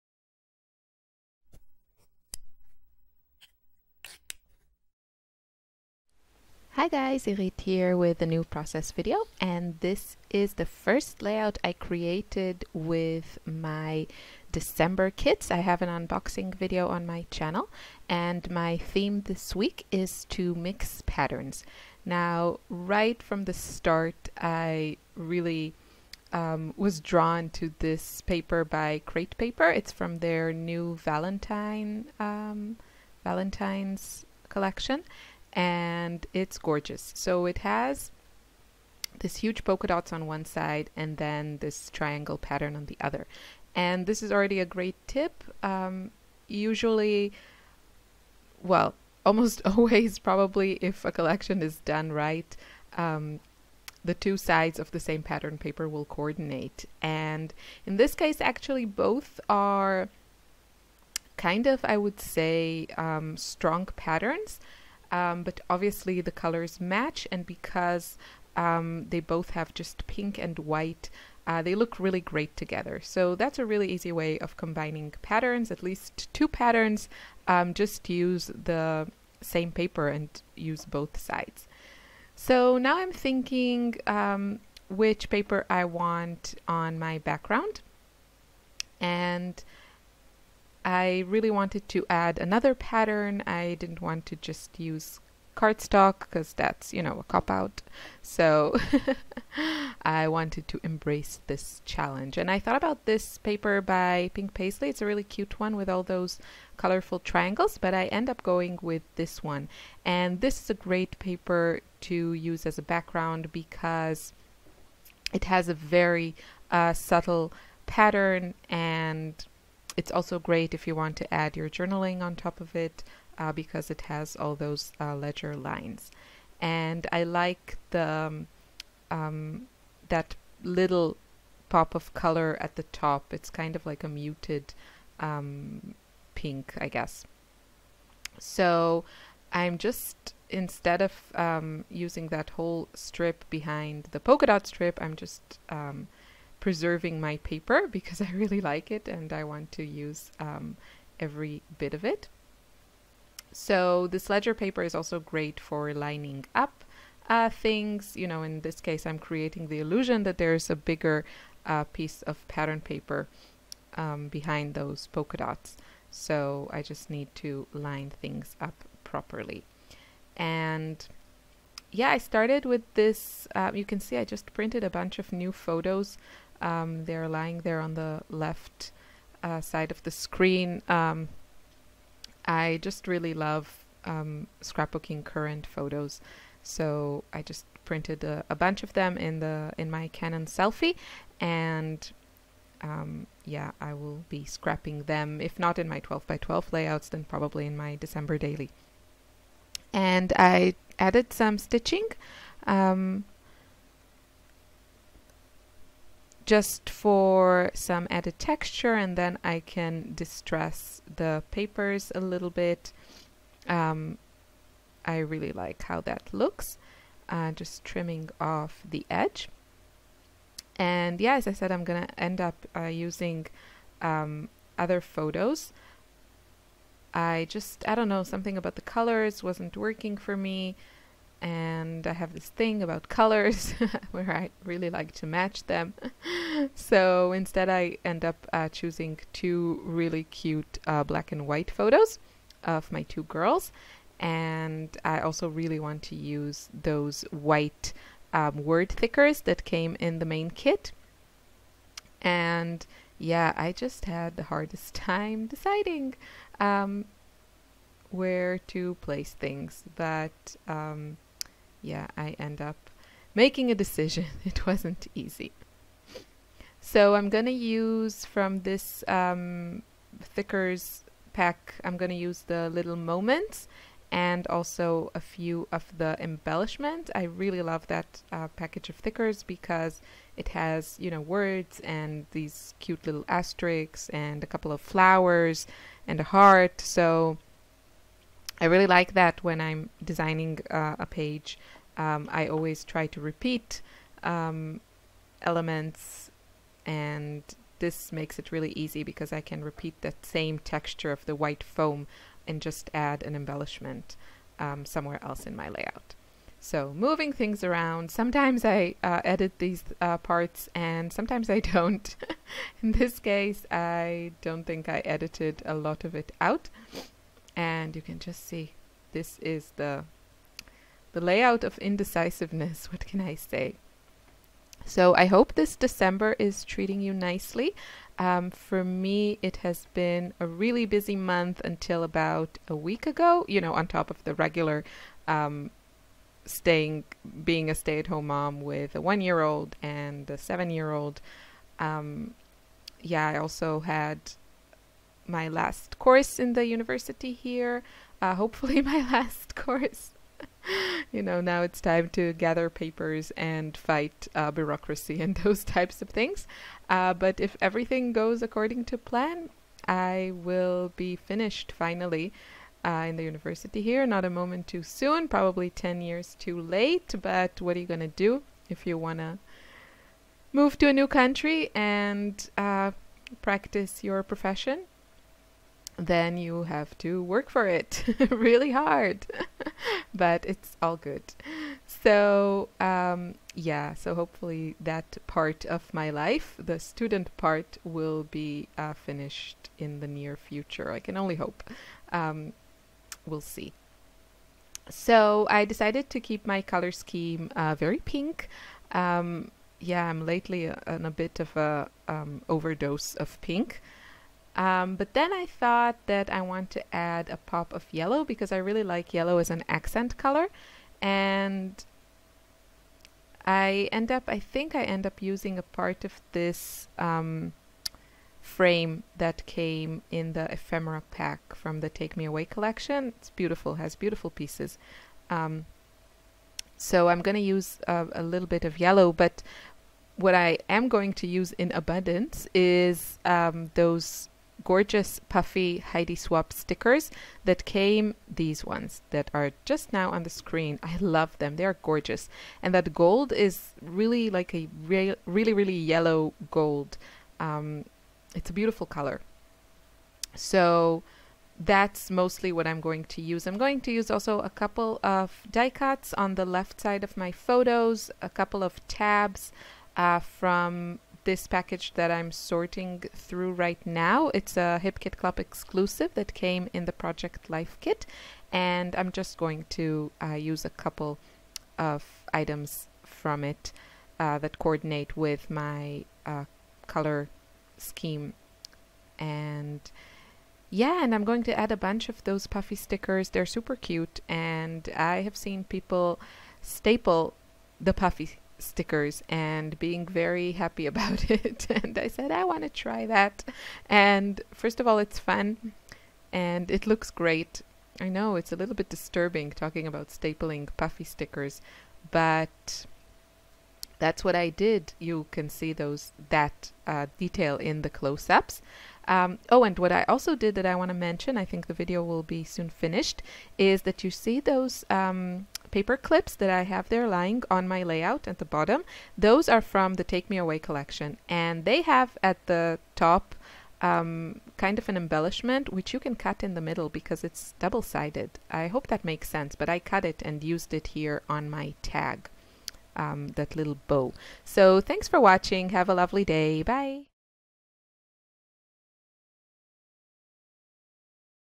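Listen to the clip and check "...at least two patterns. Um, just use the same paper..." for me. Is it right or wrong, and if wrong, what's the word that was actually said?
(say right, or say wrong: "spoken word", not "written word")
right.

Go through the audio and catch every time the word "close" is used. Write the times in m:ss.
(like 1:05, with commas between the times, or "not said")
8:27.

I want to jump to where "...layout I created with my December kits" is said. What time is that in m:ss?
0:11.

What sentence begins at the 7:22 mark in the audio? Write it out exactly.
And that gold is really like a re really, really yellow gold.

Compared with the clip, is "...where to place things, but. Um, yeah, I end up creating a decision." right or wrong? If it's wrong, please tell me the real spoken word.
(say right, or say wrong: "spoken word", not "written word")
wrong: "making", not "creating".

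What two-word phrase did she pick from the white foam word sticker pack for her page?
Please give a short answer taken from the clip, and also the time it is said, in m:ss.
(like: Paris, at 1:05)
little moments, at 4:32.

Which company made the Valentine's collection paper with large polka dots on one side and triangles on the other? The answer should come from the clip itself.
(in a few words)
Crate Paper.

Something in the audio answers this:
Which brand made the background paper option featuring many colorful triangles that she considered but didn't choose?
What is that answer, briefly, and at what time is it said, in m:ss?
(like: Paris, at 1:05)
Pink Paislee, at 1:44.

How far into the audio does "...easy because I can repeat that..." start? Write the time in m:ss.
4:58.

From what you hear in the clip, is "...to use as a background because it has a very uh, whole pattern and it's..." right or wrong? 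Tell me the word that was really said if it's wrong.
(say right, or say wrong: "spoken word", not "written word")
wrong: "subtle", not "whole".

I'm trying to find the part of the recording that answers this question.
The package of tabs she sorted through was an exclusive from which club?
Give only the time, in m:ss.
7:44.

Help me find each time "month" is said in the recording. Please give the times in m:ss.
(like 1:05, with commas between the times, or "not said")
5:31.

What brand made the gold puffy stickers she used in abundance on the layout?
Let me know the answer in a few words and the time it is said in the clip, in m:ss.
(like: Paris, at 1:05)
Heidi Swapp, at 7:15.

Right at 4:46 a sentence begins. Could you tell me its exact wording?
So I really like that when I'm designing uh, a page.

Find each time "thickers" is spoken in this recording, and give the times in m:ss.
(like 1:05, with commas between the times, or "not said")
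4:08, 4:30, 4:38.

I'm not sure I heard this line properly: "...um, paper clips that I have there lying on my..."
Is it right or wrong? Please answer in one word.
right.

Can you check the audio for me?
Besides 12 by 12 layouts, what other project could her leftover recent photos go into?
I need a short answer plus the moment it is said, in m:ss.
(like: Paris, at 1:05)
December daily, at 3:17.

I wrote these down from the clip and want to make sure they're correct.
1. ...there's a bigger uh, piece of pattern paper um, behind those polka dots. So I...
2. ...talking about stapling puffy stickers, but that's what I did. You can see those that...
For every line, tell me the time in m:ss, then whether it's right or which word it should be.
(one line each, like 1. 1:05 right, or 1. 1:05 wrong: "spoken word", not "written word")
1. 2:40 right
2. 8:19 right.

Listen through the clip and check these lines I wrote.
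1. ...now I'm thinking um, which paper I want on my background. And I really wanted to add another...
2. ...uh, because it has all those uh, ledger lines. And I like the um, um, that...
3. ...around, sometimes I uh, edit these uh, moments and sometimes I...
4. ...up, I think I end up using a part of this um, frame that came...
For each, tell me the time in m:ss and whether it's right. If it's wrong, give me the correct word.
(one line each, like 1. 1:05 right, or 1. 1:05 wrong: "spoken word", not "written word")
1. 1:22 right
2. 2:03 right
3. 5:07 wrong: "parts", not "moments"
4. 6:54 right.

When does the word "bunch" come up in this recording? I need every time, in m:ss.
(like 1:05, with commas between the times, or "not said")
2:54, 3:08, 8:01.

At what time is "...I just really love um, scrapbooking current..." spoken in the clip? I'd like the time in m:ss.
3:02.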